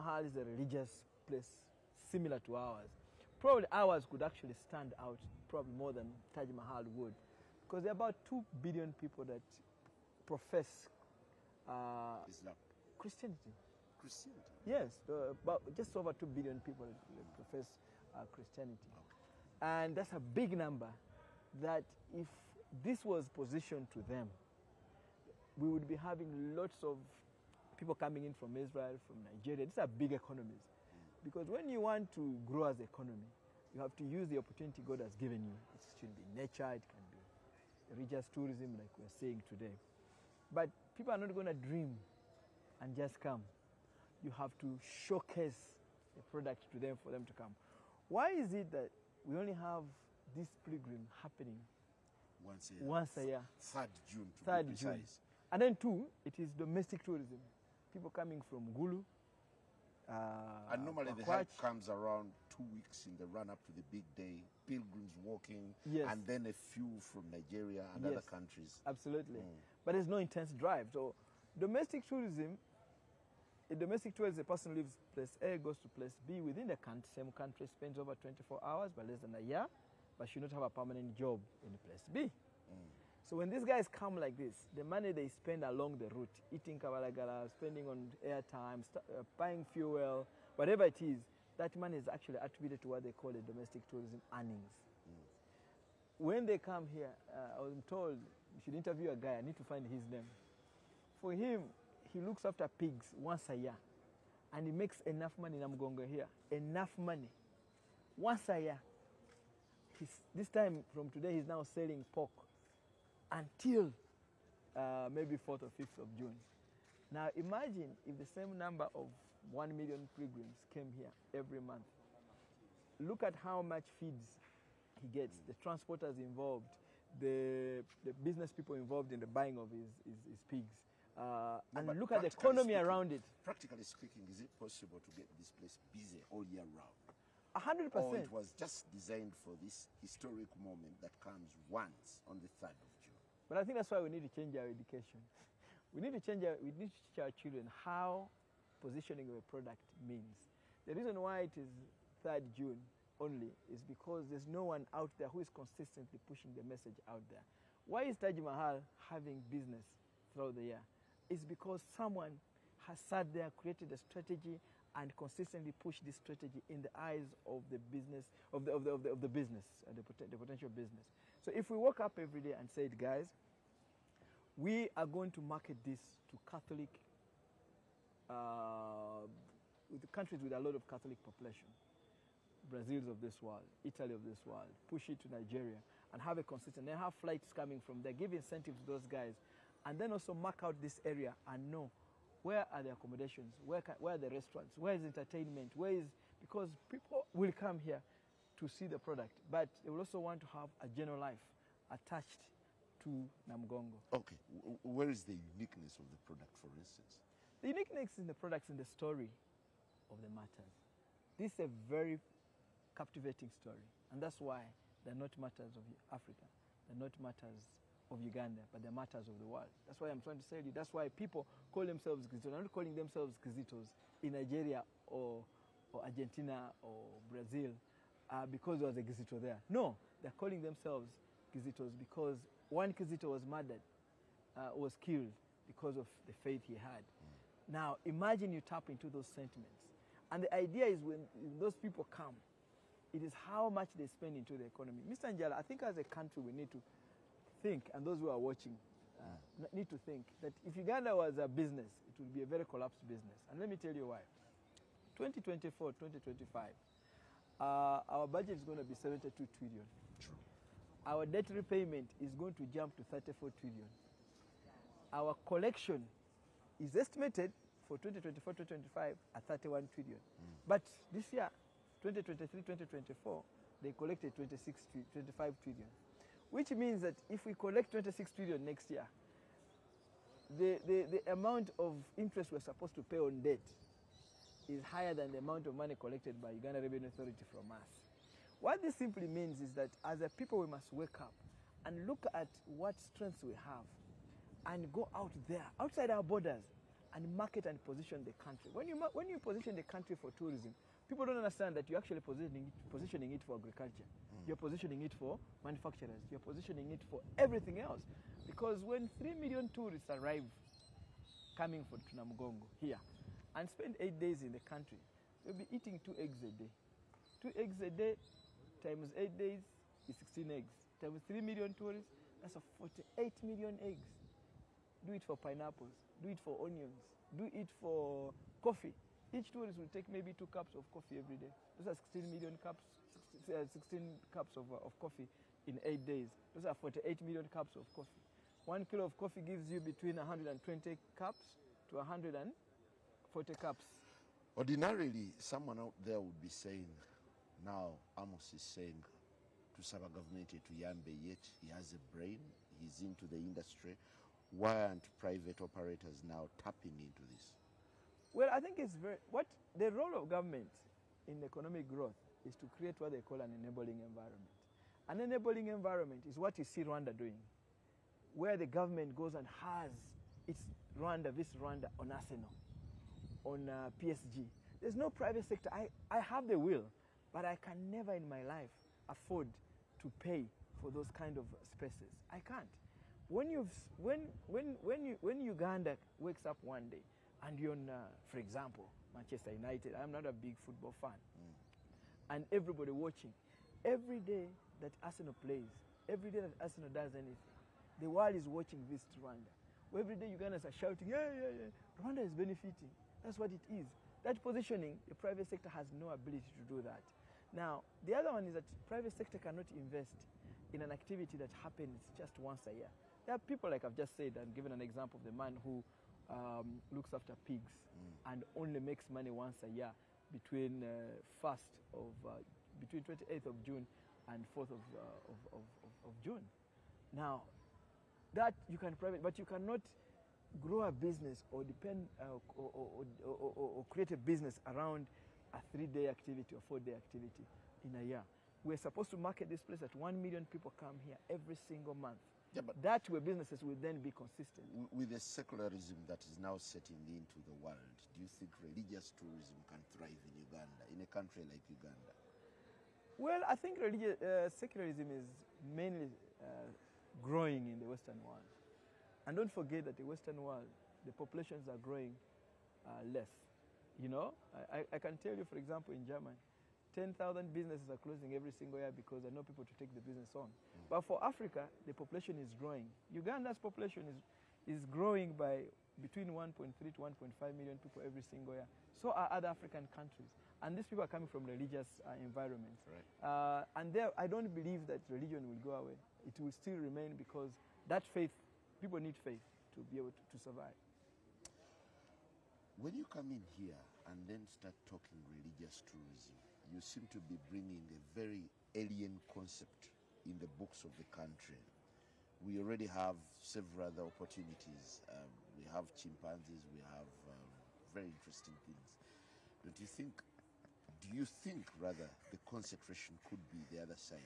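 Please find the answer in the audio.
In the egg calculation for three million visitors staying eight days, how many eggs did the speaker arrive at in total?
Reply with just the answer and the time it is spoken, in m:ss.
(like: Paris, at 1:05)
48 million, at 5:22.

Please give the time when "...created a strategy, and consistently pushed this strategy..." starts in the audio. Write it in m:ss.
2:43.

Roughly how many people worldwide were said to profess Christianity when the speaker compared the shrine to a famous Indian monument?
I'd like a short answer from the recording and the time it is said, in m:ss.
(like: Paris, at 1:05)
just over 2 billion, at 0:15.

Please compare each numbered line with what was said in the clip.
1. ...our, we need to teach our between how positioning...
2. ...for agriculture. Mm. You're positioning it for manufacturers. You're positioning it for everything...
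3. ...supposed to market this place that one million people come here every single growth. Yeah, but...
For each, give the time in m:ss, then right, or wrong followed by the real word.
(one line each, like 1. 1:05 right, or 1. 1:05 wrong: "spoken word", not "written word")
1. 2:26 wrong: "children", not "between"
2. 5:03 right
3. 7:18 wrong: "month", not "growth".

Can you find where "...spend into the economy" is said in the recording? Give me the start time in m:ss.
4:04.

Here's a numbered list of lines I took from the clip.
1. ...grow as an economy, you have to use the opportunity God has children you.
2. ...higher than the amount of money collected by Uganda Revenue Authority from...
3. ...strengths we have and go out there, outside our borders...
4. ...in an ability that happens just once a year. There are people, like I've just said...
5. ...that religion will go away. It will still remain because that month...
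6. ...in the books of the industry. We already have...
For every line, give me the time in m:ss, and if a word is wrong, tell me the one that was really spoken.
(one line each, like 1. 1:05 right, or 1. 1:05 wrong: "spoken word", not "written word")
1. 0:32 wrong: "given", not "children"
2. 4:44 right
3. 4:52 right
4. 6:50 wrong: "activity", not "ability"
5. 8:04 wrong: "faith", not "month"
6. 8:20 wrong: "country", not "industry".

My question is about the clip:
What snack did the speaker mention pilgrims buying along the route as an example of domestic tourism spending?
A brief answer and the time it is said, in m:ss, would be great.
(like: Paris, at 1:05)
kabalagala, at 1:26.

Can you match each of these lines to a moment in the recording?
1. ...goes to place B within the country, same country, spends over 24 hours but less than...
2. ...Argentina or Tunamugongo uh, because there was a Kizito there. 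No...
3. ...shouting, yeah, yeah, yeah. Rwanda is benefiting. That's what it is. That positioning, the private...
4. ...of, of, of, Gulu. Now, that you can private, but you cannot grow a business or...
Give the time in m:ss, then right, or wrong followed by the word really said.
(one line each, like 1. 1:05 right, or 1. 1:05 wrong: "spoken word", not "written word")
1. 1:15 right
2. 3:46 wrong: "Brazil", not "Tunamugongo"
3. 6:40 right
4. 7:05 wrong: "June", not "Gulu".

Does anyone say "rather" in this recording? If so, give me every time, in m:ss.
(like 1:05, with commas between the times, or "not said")
8:31.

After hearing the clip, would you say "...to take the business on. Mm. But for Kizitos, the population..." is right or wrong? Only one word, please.
wrong.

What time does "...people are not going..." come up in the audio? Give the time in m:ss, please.
0:40.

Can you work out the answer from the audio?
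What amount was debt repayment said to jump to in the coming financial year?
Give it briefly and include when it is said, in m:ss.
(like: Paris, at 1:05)
34 trillion, at 4:23.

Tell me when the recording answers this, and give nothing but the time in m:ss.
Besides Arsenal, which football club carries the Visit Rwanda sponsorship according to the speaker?
6:14.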